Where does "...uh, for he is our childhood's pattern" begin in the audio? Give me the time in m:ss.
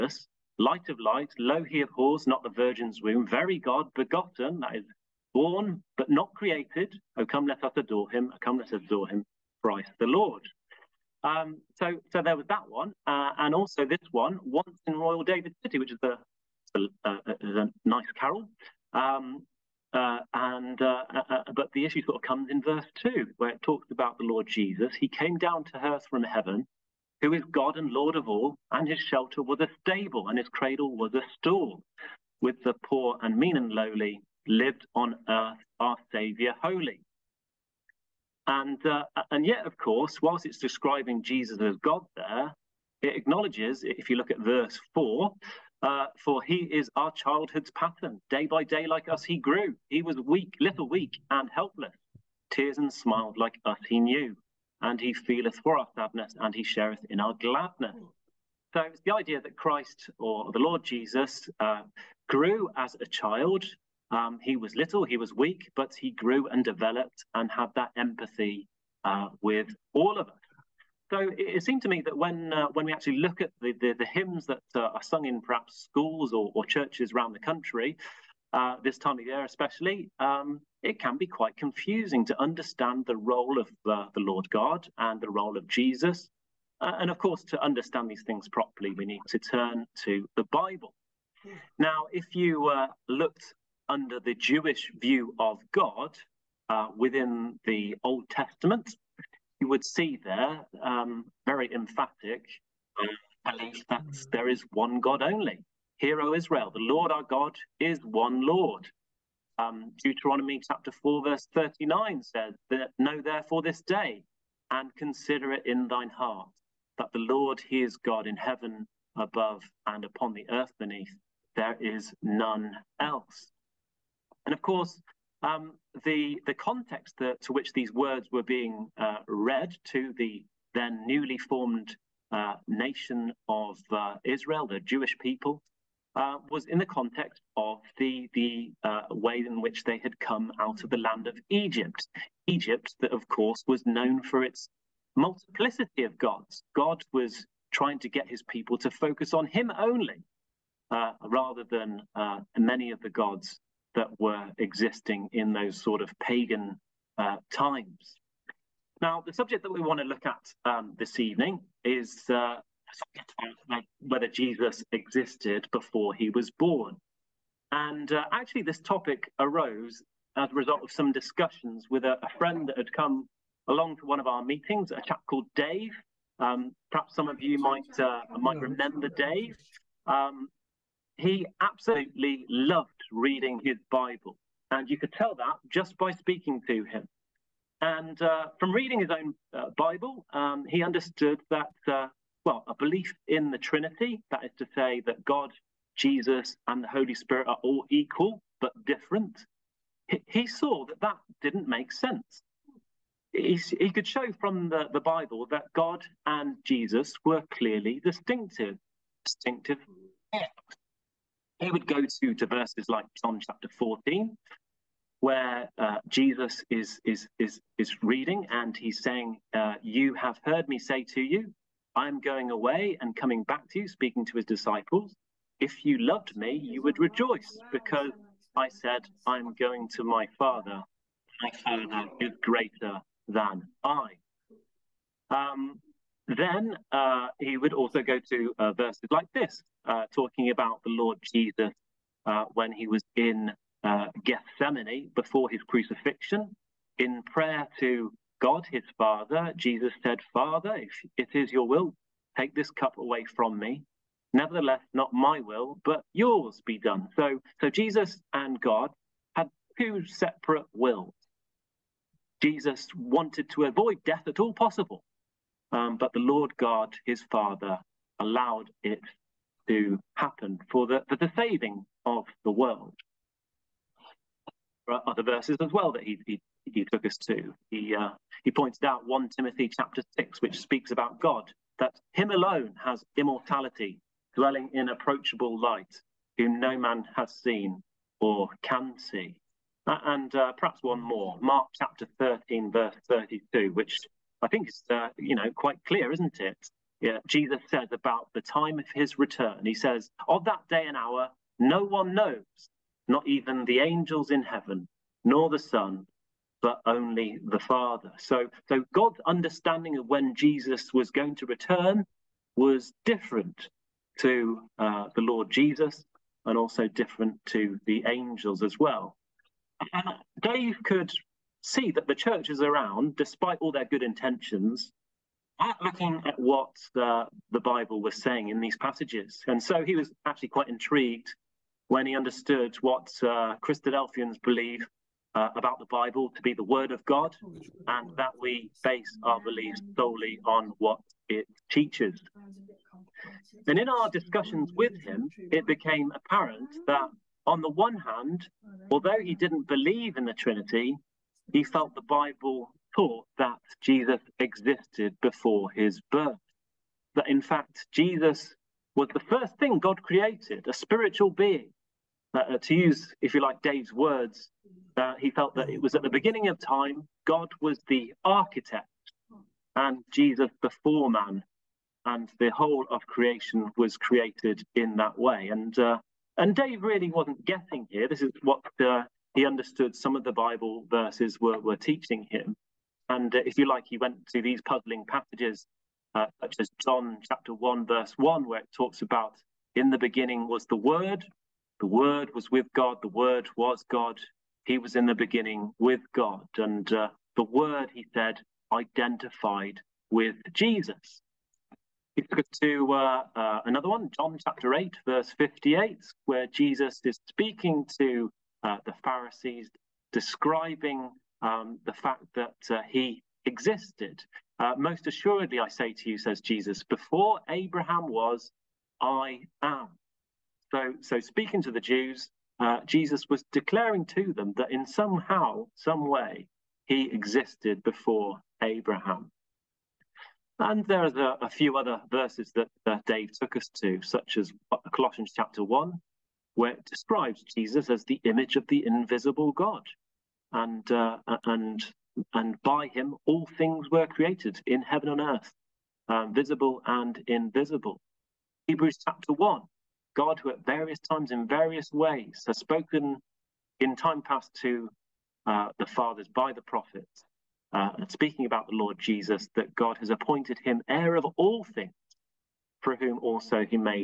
0:45.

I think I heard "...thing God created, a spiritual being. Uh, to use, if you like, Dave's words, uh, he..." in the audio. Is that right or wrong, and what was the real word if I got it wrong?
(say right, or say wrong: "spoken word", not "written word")
right.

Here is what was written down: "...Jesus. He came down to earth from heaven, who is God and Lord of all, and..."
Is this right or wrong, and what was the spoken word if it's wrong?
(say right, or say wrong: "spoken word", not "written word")
right.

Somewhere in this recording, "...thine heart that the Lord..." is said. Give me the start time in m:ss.
1:55.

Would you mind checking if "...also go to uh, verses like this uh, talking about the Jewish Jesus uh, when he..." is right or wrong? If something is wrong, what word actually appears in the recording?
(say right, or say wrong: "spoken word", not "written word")
wrong: "Lord", not "Jewish".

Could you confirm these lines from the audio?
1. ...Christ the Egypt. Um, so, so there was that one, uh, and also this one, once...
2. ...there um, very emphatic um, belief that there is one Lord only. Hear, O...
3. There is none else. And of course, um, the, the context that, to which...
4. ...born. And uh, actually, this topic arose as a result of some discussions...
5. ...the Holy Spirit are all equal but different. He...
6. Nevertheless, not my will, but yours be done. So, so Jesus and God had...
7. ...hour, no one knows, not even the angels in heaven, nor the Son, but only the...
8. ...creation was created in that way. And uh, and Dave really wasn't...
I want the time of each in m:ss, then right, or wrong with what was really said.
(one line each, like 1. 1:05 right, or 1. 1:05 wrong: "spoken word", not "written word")
1. 0:09 wrong: "Lord", not "Egypt"
2. 1:40 wrong: "God", not "Lord"
3. 2:01 right
4. 2:46 right
5. 3:16 right
6. 4:14 right
7. 5:00 right
8. 6:13 right.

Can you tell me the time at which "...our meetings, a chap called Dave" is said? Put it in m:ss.
2:54.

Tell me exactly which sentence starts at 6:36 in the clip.
And uh, the Word, he said, identified with Jesus.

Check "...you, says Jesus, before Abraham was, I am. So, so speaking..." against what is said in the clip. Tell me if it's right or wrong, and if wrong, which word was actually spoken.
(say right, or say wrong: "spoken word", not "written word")
right.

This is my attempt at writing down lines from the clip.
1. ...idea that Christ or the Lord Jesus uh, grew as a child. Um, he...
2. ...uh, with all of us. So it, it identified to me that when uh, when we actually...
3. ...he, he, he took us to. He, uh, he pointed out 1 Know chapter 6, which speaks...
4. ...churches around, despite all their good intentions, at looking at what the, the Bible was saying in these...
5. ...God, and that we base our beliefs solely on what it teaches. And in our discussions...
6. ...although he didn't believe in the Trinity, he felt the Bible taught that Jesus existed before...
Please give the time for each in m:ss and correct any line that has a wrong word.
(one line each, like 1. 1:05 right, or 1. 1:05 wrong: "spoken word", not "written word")
1. 0:59 right
2. 1:09 wrong: "seemed", not "identified"
3. 4:36 wrong: "Timothy", not "Know"
4. 5:22 right
5. 5:37 right
6. 5:48 right.